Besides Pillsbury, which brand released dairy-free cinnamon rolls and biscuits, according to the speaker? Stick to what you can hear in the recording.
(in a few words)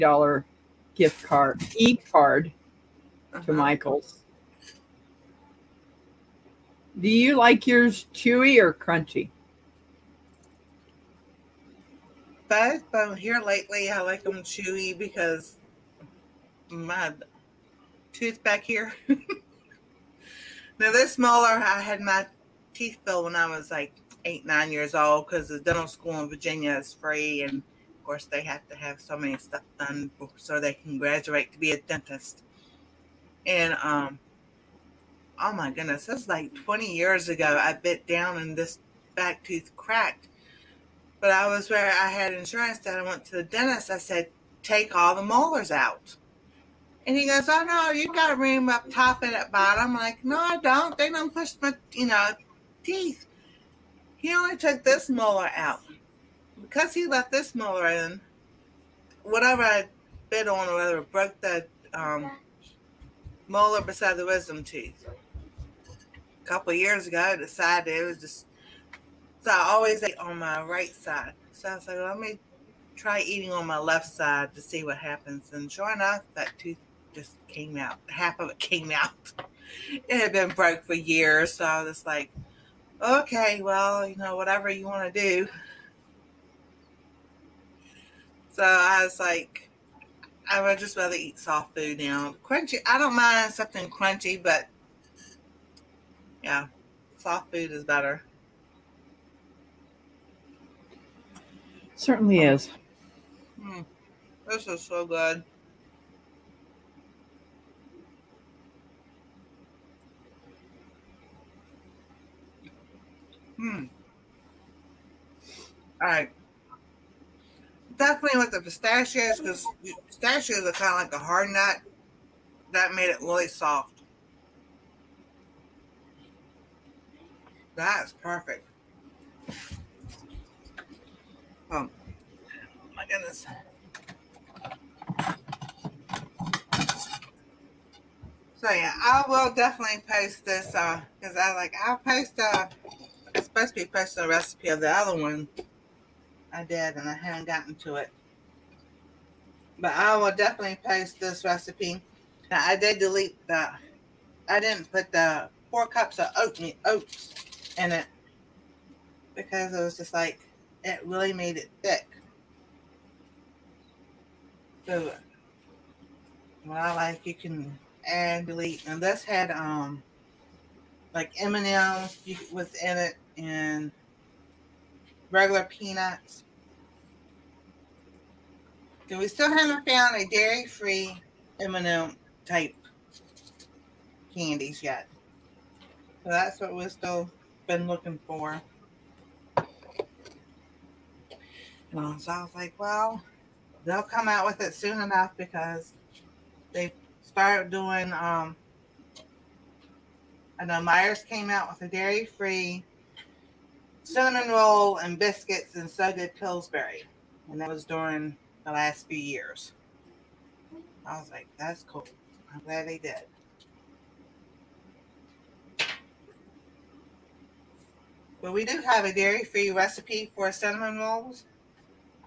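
Myers.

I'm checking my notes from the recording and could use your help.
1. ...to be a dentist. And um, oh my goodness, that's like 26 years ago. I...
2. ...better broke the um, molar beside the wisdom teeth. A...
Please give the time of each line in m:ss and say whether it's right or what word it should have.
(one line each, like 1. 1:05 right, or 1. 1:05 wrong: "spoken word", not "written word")
1. 0:31 wrong: "20", not "26"
2. 1:00 wrong: "whatever", not "better".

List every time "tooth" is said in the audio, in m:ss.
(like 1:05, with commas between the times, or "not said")
0:18, 0:39, 1:16.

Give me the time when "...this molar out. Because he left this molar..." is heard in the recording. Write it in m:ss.
0:54.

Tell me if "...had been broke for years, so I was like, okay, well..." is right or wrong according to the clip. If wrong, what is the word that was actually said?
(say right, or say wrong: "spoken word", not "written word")
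right.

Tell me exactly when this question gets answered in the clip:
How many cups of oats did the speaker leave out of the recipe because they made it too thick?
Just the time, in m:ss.
2:35.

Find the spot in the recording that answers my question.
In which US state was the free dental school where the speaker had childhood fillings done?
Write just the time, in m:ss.
0:26.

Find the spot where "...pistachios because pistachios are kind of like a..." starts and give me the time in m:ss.
1:58.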